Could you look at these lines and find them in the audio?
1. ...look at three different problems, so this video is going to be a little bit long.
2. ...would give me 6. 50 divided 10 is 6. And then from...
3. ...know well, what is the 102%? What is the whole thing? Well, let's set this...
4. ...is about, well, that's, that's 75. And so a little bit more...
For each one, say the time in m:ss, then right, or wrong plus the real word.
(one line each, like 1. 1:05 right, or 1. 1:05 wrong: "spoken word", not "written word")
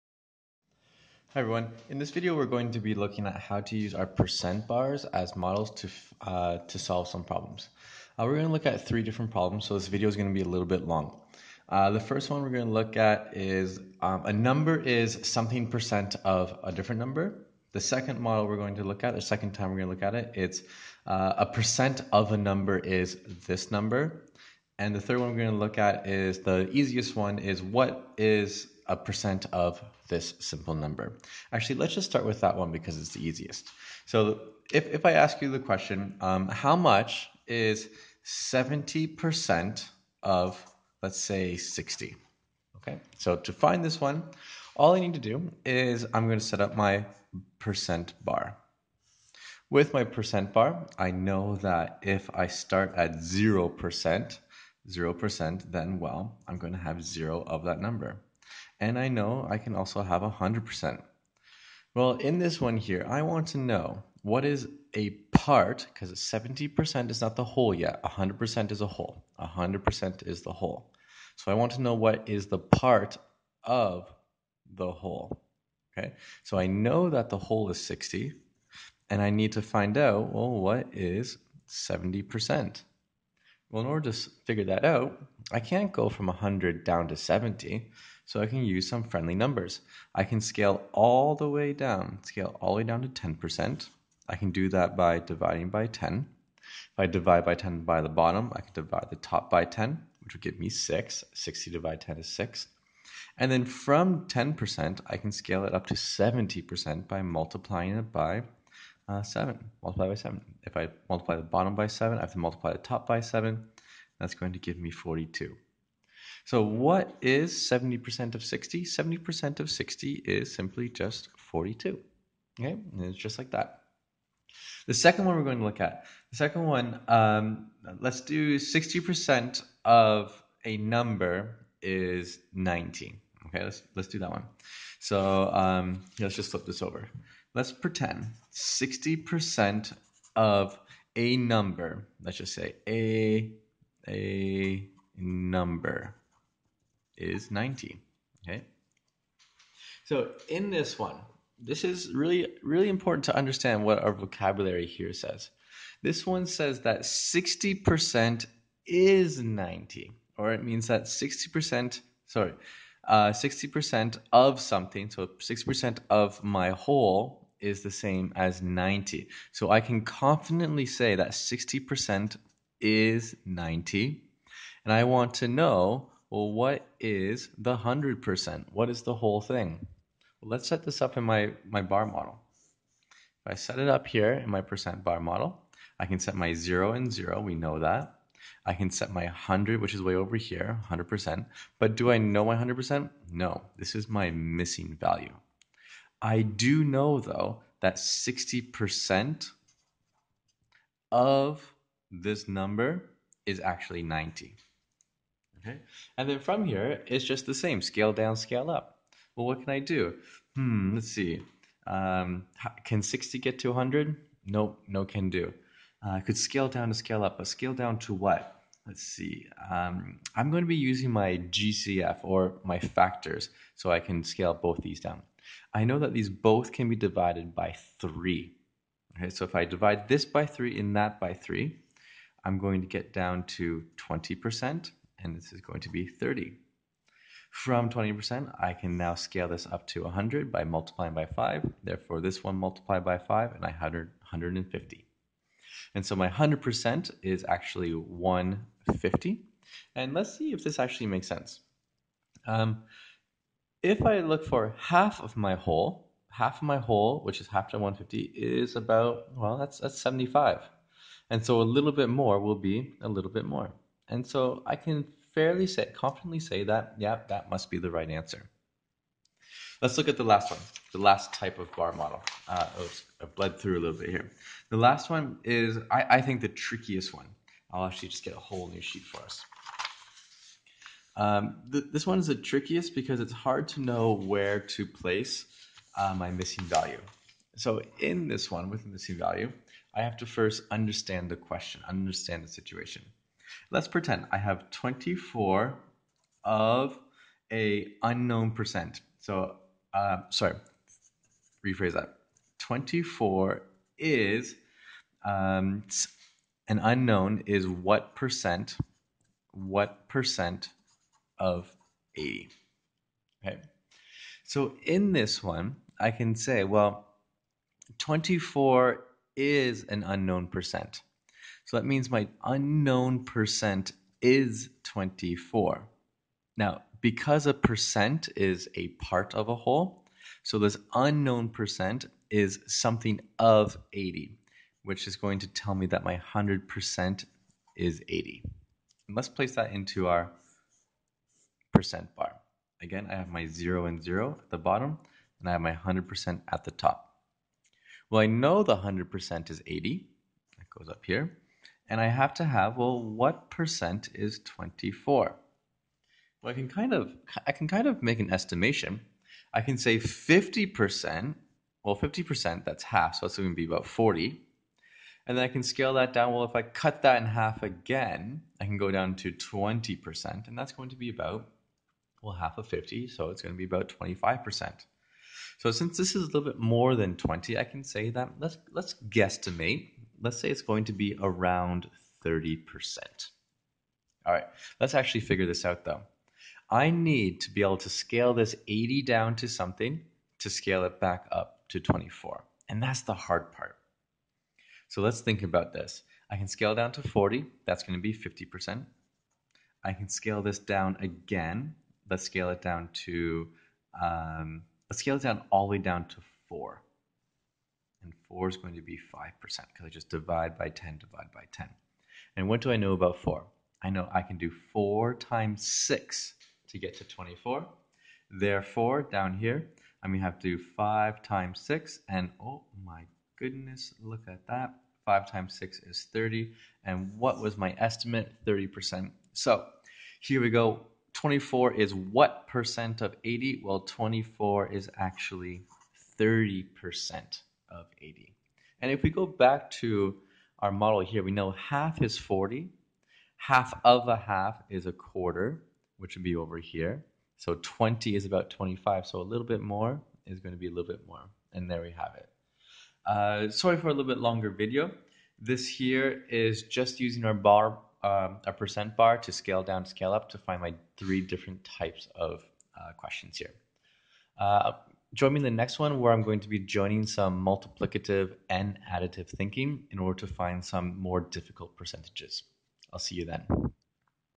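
1. 0:08 right
2. 1:40 wrong: "60", not "50"
3. 2:55 wrong: "100", not "102"
4. 4:18 right.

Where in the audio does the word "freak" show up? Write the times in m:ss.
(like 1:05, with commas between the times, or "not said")
not said.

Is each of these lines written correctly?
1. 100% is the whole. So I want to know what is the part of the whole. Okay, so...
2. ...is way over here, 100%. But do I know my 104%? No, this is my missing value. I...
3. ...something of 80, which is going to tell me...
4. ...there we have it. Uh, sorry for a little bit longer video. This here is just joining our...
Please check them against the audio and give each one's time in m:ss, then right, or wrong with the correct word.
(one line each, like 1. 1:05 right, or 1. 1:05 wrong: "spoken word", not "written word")
1. 1:09 right
2. 3:09 wrong: "100", not "104"
3. 5:32 right
4. 7:31 wrong: "using", not "joining".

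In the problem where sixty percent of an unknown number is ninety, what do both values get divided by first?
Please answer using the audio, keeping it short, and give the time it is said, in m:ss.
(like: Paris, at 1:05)
3, at 3:46.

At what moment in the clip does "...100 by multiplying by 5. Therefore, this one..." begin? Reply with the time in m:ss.
4:00.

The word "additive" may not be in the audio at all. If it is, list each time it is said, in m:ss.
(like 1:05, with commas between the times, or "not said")
7:48.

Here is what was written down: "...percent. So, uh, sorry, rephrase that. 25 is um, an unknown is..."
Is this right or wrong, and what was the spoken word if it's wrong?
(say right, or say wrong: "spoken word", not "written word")
wrong: "24", not "25".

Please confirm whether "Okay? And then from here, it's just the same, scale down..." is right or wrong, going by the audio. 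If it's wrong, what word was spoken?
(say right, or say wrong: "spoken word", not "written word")
right.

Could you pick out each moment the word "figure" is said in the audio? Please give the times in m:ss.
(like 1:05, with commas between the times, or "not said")
1:24, 6:25.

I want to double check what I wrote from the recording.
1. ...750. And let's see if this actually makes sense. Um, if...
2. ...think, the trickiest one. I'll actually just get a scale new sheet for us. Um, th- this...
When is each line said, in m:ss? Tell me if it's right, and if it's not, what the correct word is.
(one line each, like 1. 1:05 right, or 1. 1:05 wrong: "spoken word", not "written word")
1. 4:07 wrong: "150", not "750"
2. 4:36 wrong: "whole", not "scale".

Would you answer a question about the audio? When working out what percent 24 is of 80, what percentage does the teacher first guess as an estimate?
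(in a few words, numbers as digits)
30%.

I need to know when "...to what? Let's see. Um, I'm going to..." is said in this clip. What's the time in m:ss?
3:37.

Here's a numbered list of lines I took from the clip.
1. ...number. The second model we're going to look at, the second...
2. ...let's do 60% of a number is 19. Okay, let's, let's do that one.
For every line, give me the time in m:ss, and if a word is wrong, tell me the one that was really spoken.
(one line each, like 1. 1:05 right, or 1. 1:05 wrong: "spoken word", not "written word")
1. 0:16 right
2. 2:08 right.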